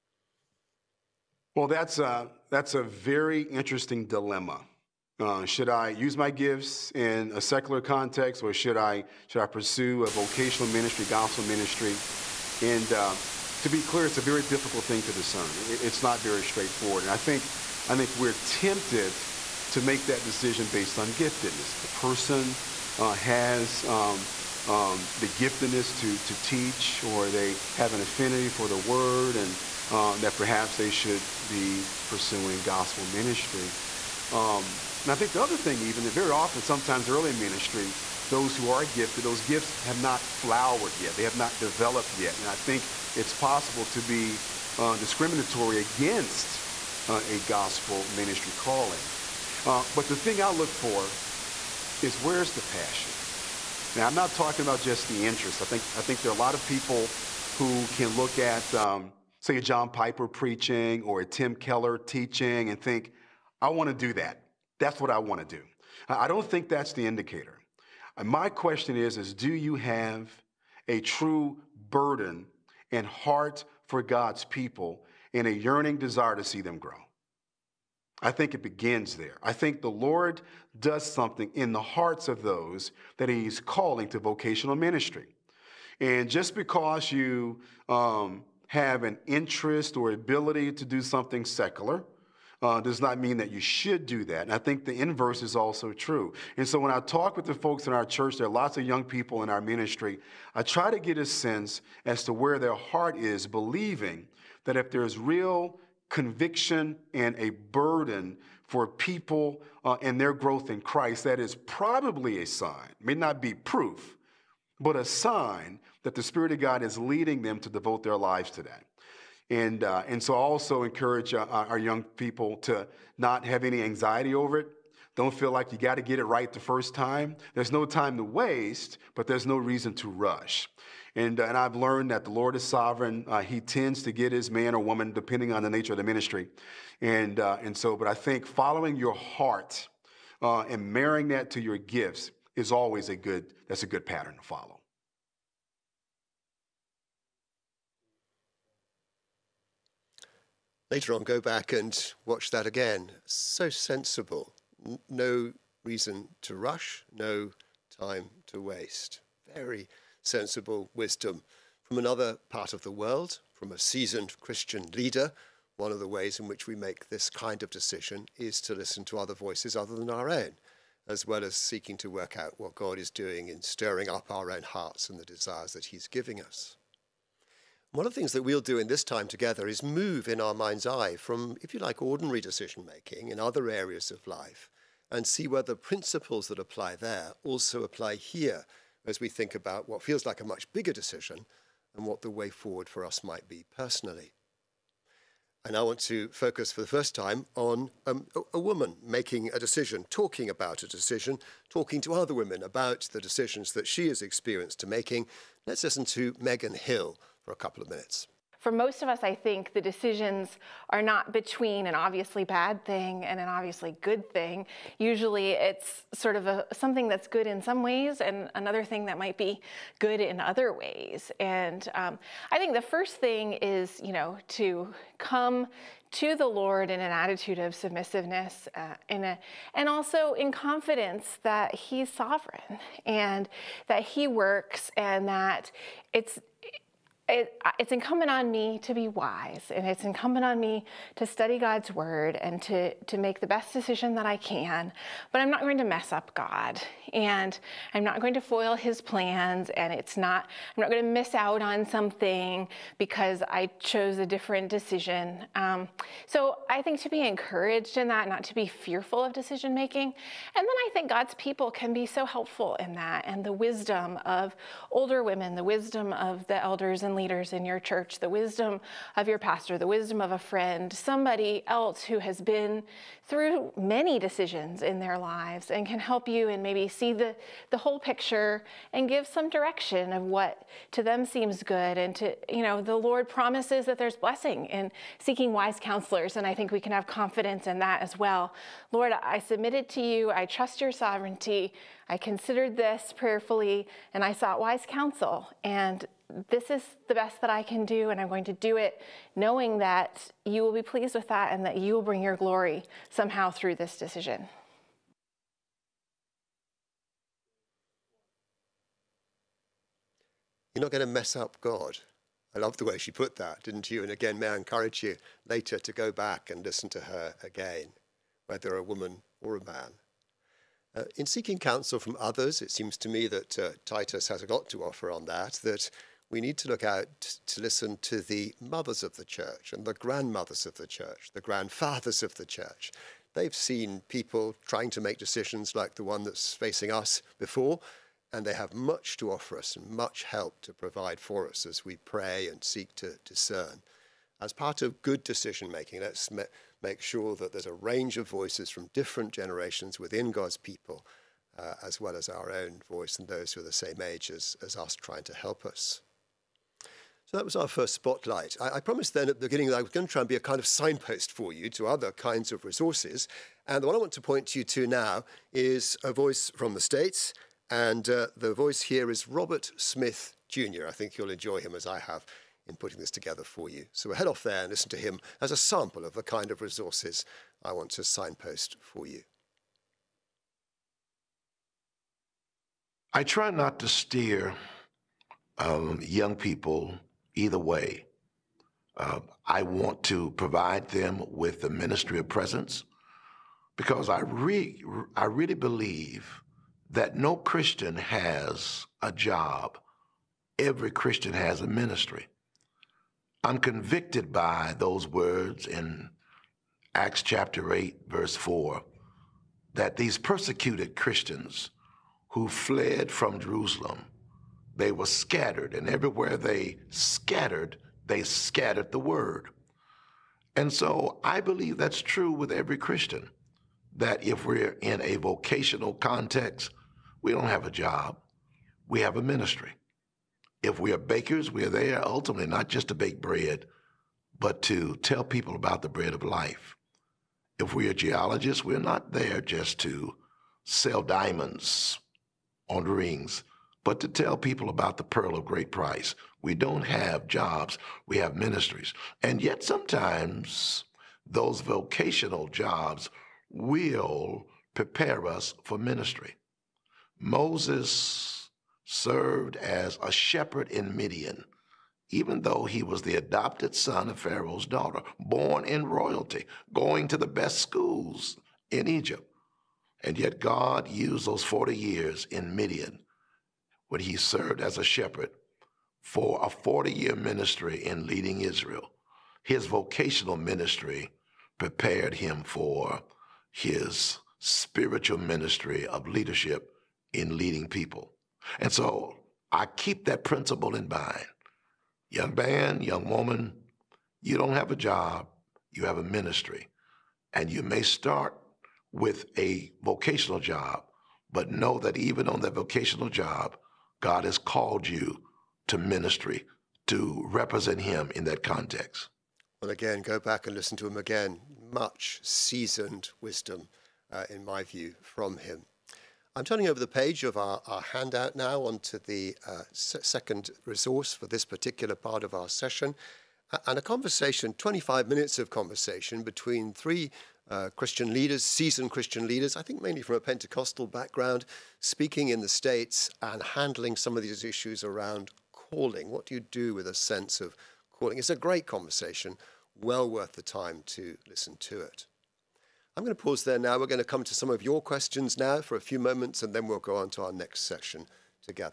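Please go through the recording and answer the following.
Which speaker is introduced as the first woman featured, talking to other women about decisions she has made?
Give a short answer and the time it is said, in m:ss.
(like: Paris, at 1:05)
Megan Hill, at 3:26.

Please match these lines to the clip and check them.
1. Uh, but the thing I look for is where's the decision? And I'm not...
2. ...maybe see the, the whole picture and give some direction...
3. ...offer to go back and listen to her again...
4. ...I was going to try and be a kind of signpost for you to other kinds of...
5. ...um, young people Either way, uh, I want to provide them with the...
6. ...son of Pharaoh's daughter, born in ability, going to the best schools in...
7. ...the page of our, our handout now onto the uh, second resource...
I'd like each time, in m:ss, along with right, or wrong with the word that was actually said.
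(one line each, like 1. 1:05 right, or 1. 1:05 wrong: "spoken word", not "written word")
1. 0:49 wrong: "passion", not "decision"
2. 4:36 right
3. 5:15 wrong: "later", not "offer"
4. 5:59 right
5. 6:25 right
6. 7:43 wrong: "royalty", not "ability"
7. 8:36 right.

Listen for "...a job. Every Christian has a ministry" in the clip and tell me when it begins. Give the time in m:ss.
6:39.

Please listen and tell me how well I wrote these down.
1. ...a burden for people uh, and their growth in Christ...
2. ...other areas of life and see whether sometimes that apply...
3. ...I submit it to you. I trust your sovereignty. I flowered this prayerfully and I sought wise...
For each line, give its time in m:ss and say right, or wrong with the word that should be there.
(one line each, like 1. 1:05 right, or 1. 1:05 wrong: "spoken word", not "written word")
1. 1:47 right
2. 3:03 wrong: "principles", not "sometimes"
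3. 4:49 wrong: "considered", not "flowered".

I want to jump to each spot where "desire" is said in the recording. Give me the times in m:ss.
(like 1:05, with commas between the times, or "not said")
1:15, 2:55.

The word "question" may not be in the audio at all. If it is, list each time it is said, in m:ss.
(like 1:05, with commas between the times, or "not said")
1:08, 9:04.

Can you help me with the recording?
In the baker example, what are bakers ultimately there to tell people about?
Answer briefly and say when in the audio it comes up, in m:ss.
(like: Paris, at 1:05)
The bread of life, at 7:15.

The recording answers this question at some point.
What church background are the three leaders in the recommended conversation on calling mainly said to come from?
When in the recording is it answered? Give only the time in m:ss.
8:50.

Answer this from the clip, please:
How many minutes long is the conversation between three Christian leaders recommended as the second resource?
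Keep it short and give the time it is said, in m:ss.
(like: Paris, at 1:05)
25, at 8:44.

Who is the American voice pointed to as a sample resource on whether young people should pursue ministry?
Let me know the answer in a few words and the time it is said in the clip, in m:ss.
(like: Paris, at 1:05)
Robert Smith Jr., at 6:09.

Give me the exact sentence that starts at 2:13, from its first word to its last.
Uh, he tends to get his man or woman depending on the nature of the ministry.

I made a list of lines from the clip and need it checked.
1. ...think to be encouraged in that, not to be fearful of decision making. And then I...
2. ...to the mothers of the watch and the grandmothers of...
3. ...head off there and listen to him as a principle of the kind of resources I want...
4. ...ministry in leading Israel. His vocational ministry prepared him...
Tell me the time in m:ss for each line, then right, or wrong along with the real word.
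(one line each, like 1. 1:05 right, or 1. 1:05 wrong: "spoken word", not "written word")
1. 4:16 right
2. 5:28 wrong: "church", not "watch"
3. 6:14 wrong: "sample", not "principle"
4. 7:57 right.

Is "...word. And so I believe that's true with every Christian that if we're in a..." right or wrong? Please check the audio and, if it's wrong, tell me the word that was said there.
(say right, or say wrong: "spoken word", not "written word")
right.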